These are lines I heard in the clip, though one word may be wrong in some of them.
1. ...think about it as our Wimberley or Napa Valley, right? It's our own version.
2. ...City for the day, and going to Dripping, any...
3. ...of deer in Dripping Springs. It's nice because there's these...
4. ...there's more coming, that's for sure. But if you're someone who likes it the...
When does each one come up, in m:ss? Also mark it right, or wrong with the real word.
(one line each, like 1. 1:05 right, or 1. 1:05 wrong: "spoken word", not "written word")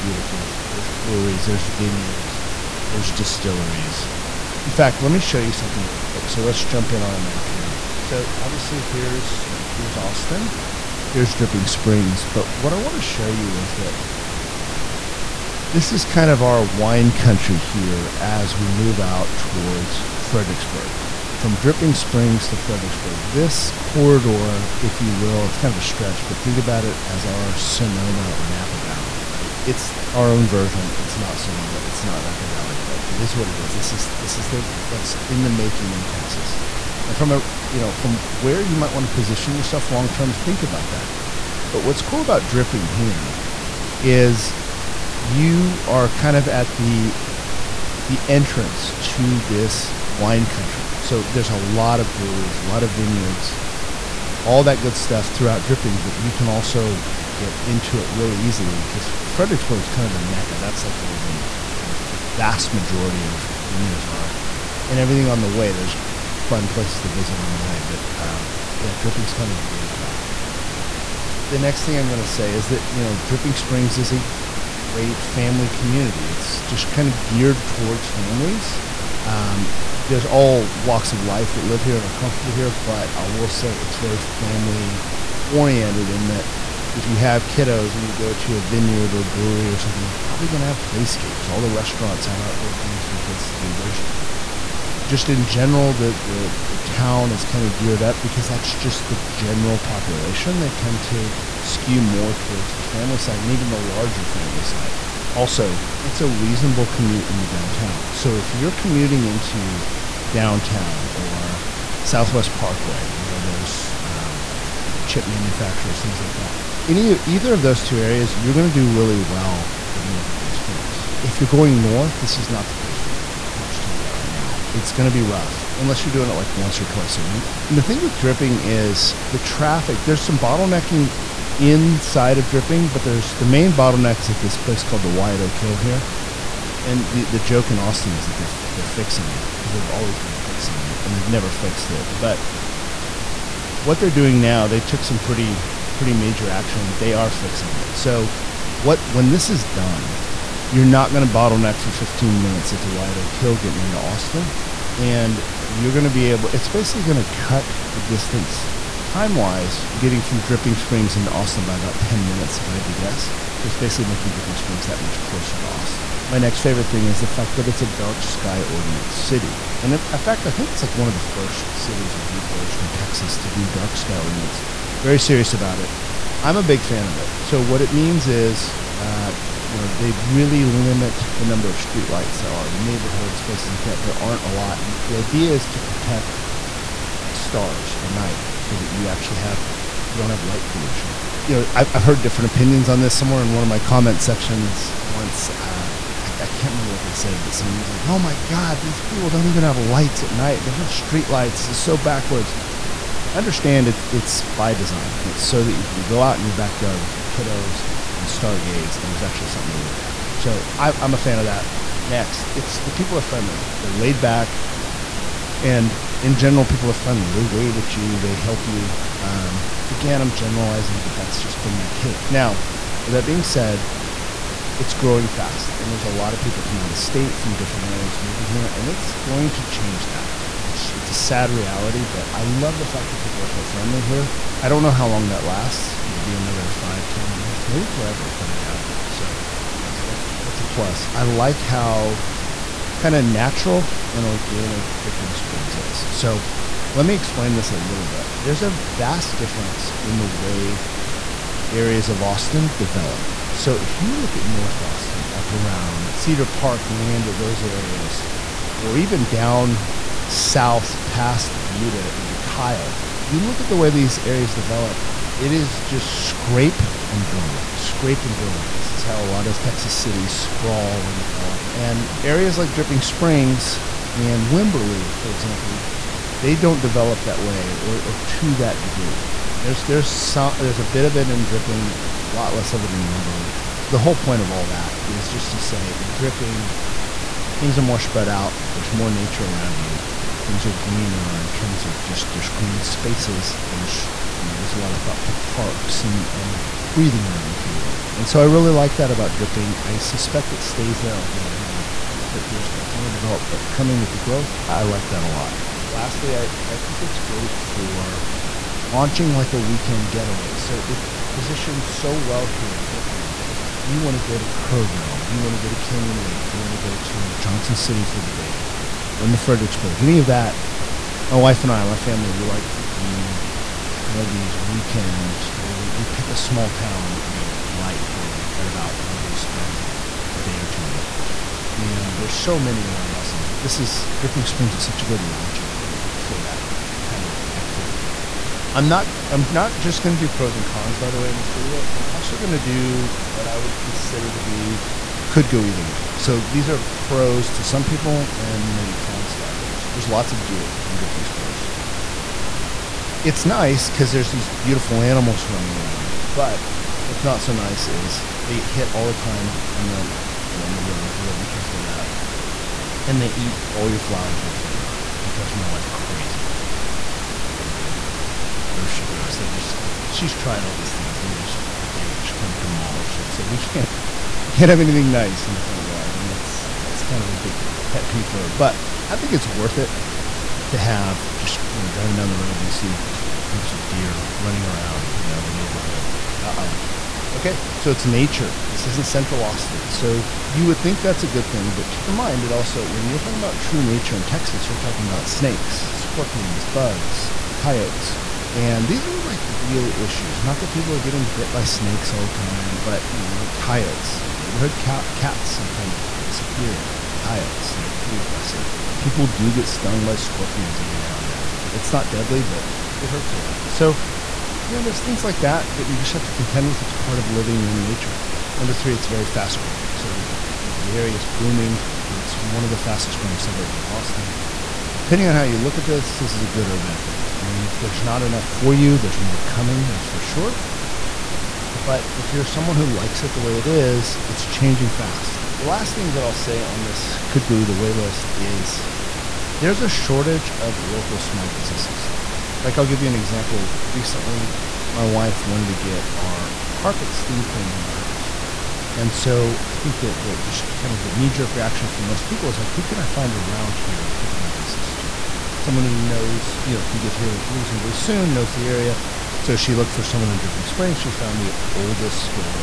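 1. 0:26 wrong: "Sonoma", not "Wimberley"
2. 5:17 wrong: "Fredericksburg", not "Dripping"
3. 5:50 right
4. 7:08 right.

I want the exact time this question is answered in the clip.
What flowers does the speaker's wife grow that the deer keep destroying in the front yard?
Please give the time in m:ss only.
6:07.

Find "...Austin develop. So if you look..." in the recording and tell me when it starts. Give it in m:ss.
4:12.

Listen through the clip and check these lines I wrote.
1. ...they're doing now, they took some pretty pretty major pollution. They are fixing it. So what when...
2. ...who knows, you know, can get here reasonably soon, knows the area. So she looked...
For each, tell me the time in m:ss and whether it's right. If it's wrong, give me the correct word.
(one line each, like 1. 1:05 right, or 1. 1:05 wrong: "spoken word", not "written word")
1. 2:23 wrong: "action", not "pollution"
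2. 7:35 right.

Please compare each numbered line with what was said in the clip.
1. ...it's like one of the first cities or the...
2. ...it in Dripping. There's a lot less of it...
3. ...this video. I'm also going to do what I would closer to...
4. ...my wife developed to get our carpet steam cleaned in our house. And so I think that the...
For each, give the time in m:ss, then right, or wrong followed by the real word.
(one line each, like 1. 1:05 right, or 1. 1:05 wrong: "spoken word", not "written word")
1. 2:50 right
2. 4:41 right
3. 5:41 wrong: "consider", not "closer"
4. 7:24 wrong: "wanted", not "developed".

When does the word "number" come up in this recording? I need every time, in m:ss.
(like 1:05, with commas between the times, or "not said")
3:01, 6:58.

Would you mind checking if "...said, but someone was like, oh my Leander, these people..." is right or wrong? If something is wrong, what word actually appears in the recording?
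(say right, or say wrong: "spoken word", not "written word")
wrong: "God", not "Leander".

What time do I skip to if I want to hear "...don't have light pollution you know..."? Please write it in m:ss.
3:10.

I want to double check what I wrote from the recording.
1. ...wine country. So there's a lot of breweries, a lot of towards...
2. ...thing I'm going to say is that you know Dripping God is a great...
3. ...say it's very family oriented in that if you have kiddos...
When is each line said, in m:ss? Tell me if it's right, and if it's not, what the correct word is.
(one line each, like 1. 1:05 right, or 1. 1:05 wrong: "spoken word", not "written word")
1. 0:50 wrong: "vineyards", not "towards"
2. 1:11 wrong: "Springs", not "God"
3. 1:23 right.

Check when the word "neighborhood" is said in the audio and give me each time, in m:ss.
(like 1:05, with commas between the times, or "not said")
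3:02, 6:25, 6:44.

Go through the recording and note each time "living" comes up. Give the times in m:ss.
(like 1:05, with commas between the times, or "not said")
1:59, 6:57.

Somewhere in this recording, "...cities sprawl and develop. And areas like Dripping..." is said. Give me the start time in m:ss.
4:29.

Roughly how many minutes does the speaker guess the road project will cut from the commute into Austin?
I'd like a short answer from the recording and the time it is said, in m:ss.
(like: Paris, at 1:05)
10 minutes, at 2:41.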